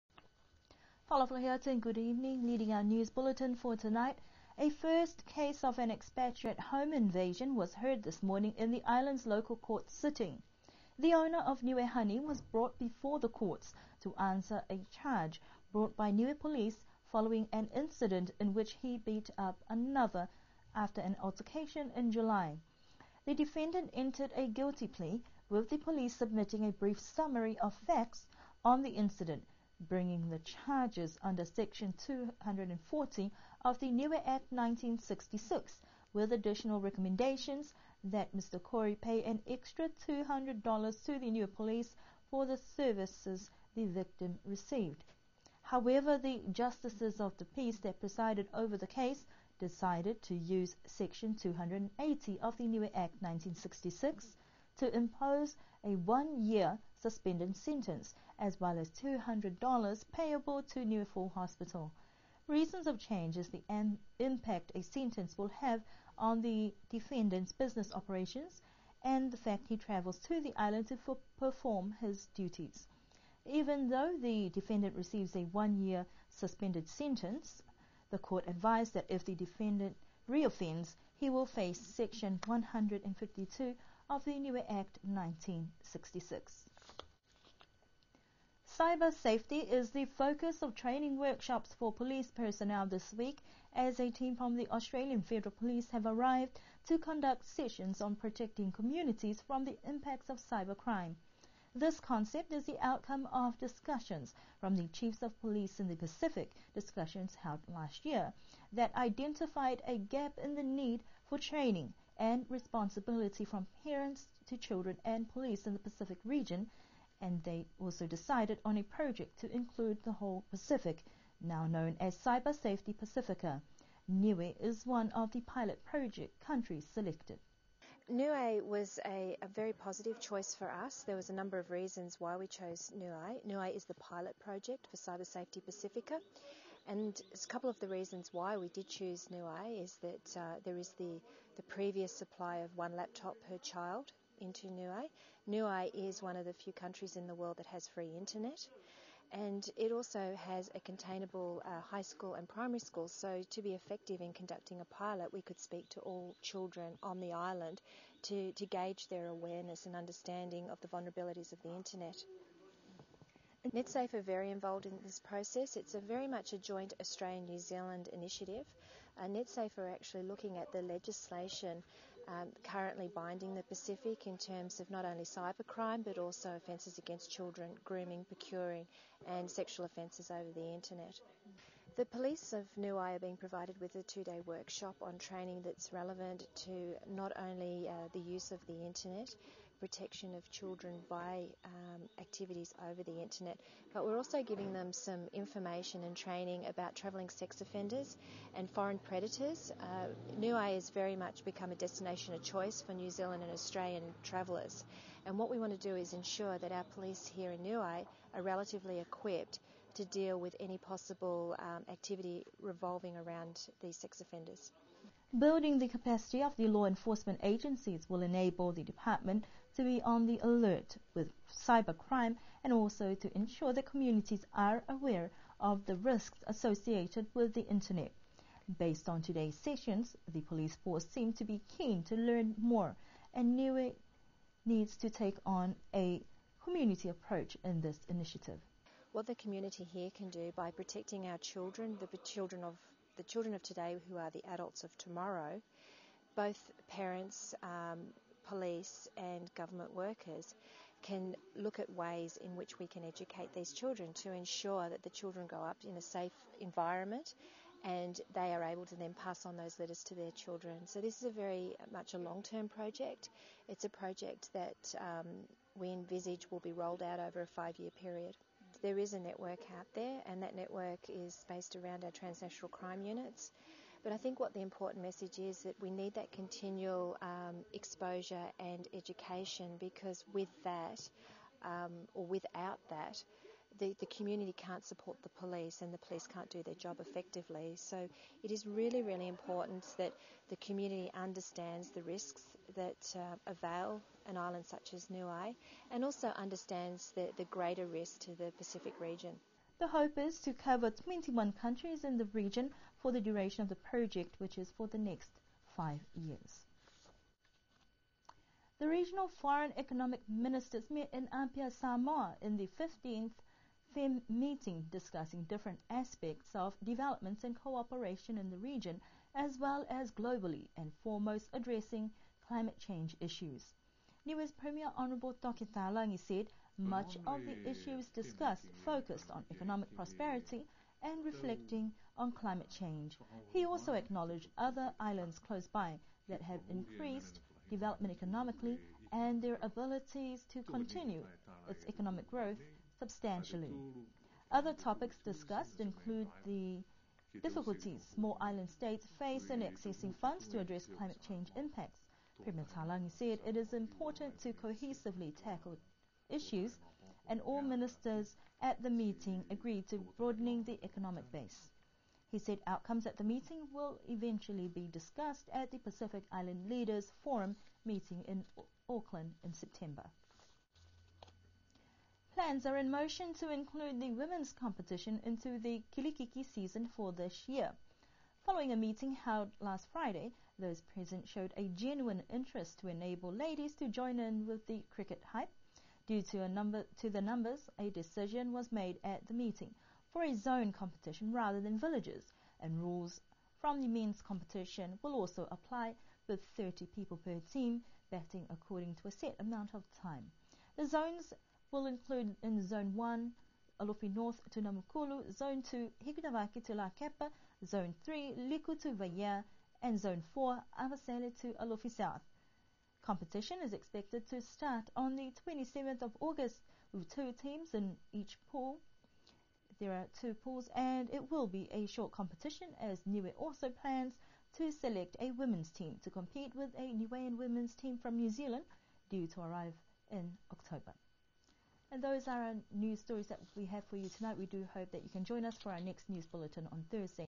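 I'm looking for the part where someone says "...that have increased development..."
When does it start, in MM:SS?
05:36.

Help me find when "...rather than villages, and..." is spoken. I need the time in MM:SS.
06:31.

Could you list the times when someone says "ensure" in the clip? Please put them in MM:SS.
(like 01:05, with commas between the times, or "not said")
03:26, 03:43, 04:14.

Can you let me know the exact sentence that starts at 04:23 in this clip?
It's a project that um, we envisage will be rolled out over a five-year period.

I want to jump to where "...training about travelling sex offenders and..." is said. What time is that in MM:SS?
03:16.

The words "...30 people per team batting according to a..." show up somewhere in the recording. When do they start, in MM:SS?
06:36.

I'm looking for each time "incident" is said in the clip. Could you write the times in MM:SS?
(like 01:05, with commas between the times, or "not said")
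00:17, 00:28.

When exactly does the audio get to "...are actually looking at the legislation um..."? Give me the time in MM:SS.
02:49.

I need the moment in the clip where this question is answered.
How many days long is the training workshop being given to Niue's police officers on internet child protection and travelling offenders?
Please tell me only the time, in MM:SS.
03:04.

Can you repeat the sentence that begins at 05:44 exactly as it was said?
Other topics discussed include the difficulties small island states face in accessing funds to address climate change impacts.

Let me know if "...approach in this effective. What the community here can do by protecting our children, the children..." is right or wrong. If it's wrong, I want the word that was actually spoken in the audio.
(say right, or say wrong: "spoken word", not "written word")
wrong: "initiative", not "effective".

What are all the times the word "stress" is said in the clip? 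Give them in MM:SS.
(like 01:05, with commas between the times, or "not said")
not said.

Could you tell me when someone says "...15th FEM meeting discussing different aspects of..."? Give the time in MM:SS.
05:12.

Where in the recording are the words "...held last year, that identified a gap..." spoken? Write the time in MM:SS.
01:47.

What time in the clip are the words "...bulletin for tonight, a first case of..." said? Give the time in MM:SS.
00:03.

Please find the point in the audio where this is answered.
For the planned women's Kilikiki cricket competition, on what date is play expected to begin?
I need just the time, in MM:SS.
06:55.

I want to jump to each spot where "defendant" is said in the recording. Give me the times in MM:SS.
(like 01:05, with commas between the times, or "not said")
00:23, 01:06, 01:14, 01:19.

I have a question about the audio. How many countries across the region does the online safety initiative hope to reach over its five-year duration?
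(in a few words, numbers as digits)
21.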